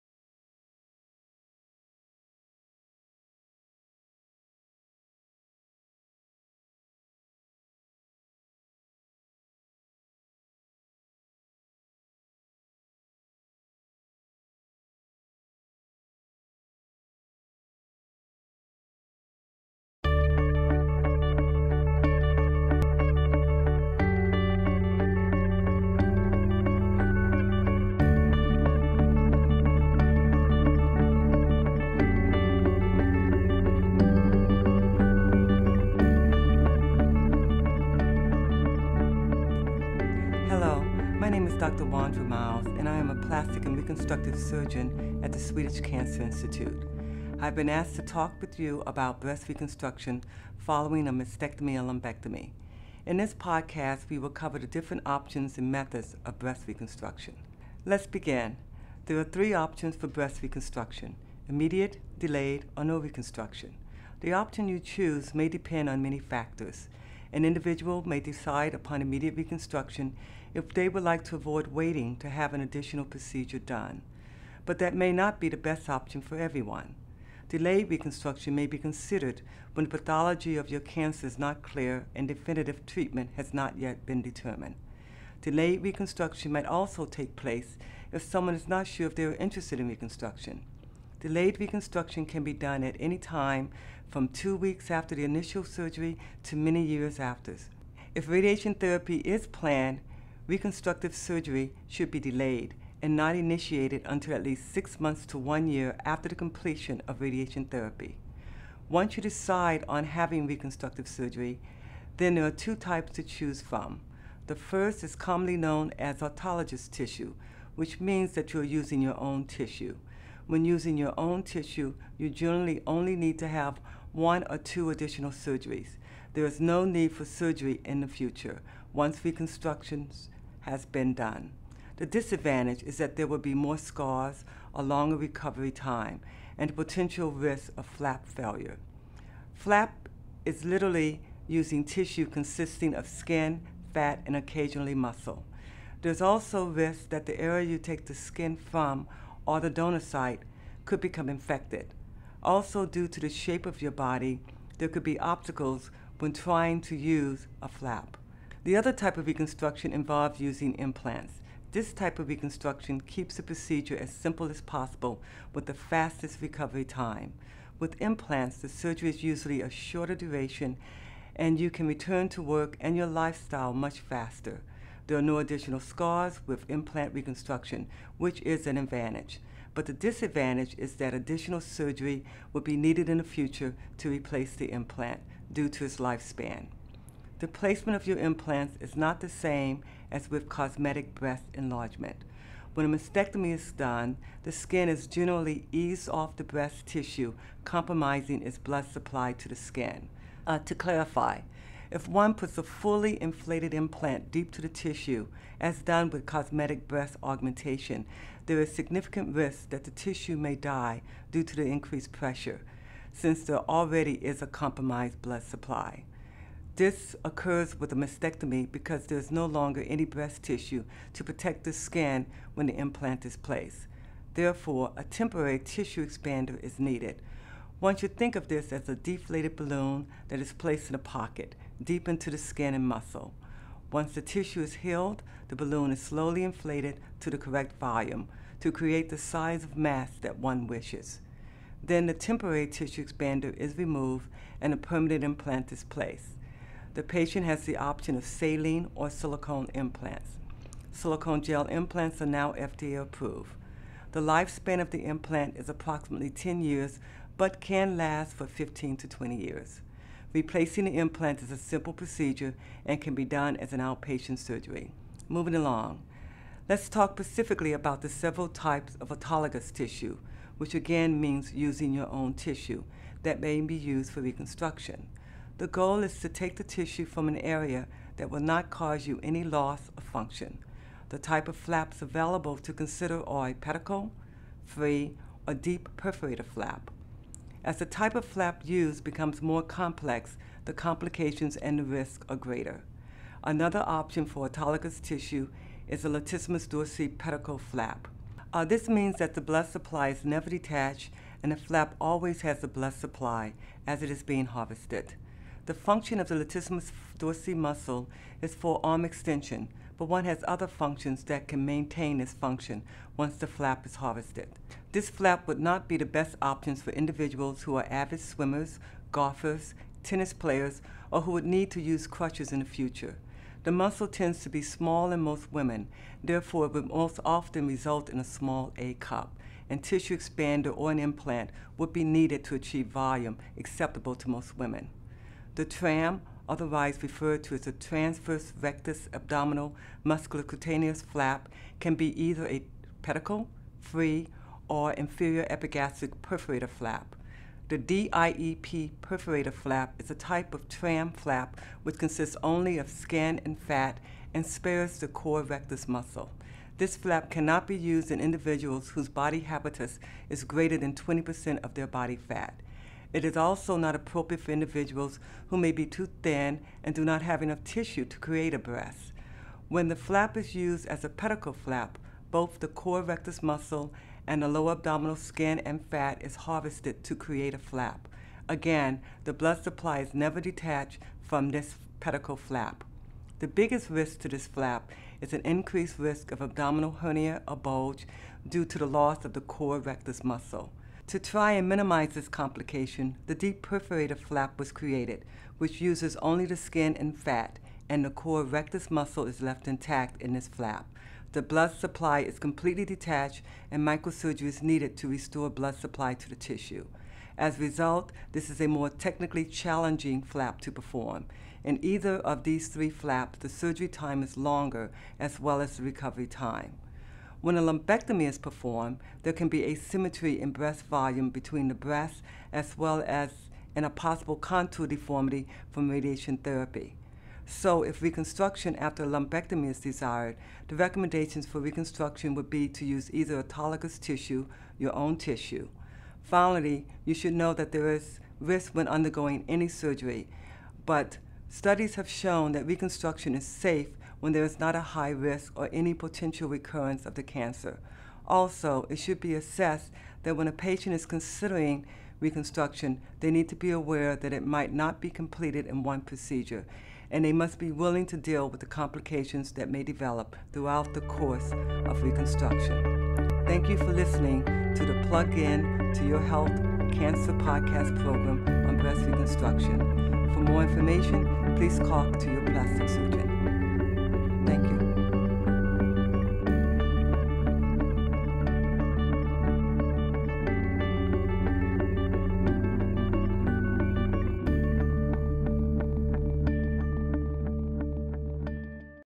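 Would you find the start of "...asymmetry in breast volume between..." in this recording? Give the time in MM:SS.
06:59.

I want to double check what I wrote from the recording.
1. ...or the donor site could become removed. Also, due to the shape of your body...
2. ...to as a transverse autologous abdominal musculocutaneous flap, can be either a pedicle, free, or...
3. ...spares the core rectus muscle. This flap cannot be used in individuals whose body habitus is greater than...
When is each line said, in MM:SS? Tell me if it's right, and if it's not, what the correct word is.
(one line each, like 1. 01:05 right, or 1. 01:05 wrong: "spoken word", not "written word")
1. 02:29 wrong: "infected", not "removed"
2. 05:37 wrong: "rectus", not "autologous"
3. 05:54 right.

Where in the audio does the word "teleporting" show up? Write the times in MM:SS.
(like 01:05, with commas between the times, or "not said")
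not said.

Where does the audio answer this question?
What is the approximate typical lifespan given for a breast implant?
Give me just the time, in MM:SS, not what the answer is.
04:16.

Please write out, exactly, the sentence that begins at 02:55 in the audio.
There are no additional scars with implant reconstruction, which is an advantage.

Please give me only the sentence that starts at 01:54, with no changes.
The first is commonly known as autologous tissue, which means that you're using your own tissue.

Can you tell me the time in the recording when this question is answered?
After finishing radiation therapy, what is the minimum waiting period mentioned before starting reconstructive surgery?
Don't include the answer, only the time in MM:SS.
01:44.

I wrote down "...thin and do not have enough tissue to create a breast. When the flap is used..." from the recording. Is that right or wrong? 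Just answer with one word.
right.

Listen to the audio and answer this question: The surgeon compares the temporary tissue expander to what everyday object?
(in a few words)
deflated balloon.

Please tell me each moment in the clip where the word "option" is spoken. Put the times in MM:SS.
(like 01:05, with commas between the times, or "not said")
00:55, 00:59, 01:04, 01:15, 04:07, 04:53, 05:16.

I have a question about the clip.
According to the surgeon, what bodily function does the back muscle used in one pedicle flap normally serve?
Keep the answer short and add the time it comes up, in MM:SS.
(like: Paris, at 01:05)
arm extension, at 05:08.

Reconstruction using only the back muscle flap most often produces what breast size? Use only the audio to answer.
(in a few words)
small A cup.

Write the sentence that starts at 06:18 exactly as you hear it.
Again, the blood supply is never detached from this pedicle flap.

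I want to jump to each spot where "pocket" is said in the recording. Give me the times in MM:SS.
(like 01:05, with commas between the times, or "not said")
03:50.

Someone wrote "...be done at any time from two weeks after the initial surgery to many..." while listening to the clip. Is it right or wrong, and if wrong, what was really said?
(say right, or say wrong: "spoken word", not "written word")
right.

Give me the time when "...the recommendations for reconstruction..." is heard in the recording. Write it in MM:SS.
07:10.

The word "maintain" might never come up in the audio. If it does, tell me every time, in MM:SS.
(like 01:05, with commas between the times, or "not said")
05:11.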